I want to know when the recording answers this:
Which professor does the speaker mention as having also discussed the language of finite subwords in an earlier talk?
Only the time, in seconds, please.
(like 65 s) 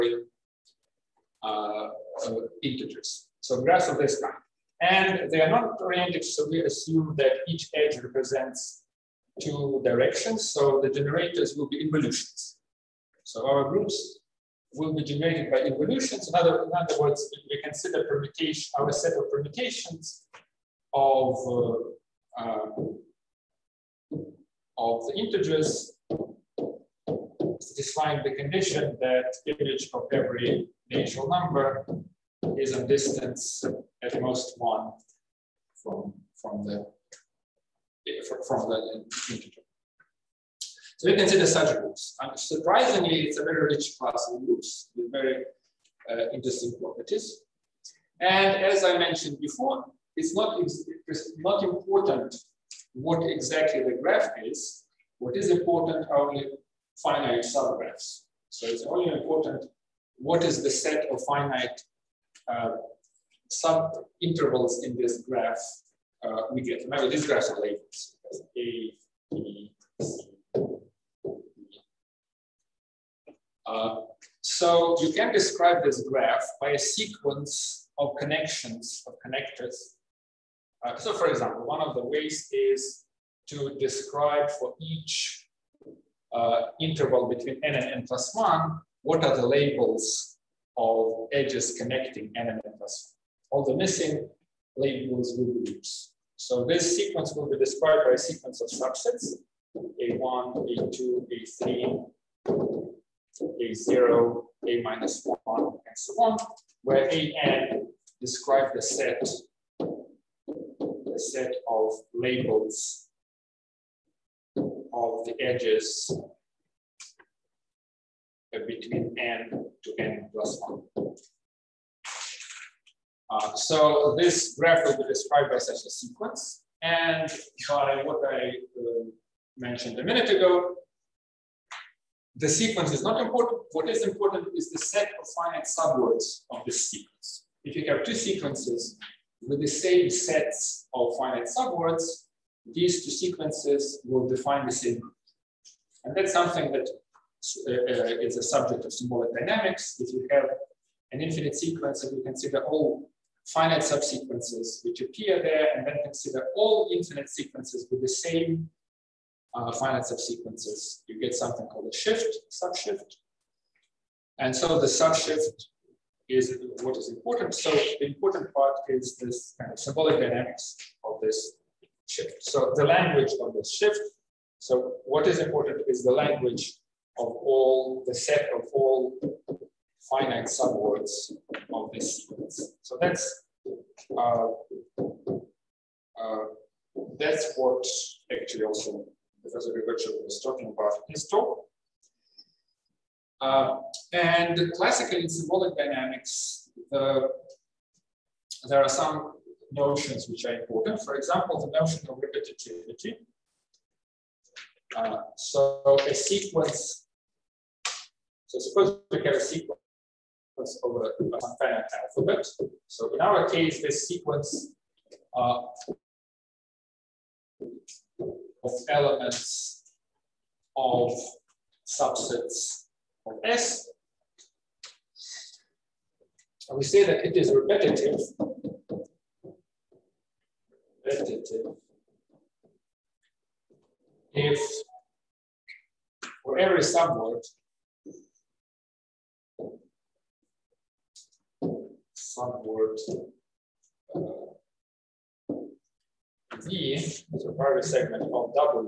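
189 s.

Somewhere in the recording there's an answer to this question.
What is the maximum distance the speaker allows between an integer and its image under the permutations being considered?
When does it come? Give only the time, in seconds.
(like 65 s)
34 s.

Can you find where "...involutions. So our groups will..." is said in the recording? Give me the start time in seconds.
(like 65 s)
11 s.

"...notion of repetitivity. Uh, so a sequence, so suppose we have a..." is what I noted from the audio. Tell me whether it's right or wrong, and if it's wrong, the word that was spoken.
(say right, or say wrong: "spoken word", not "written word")
right.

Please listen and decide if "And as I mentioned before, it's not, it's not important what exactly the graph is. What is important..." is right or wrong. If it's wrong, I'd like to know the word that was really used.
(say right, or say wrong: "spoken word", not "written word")
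right.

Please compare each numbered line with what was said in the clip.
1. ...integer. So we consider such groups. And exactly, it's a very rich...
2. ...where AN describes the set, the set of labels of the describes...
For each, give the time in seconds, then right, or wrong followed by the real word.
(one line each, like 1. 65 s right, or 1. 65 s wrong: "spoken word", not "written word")
1. 39 s wrong: "surprisingly", not "exactly"
2. 106 s wrong: "edges", not "describes".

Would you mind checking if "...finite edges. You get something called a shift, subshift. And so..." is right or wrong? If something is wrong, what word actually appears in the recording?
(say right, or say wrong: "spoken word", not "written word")
wrong: "subsequences", not "edges".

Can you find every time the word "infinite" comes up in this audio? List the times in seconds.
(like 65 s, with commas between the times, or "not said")
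151 s, 156 s.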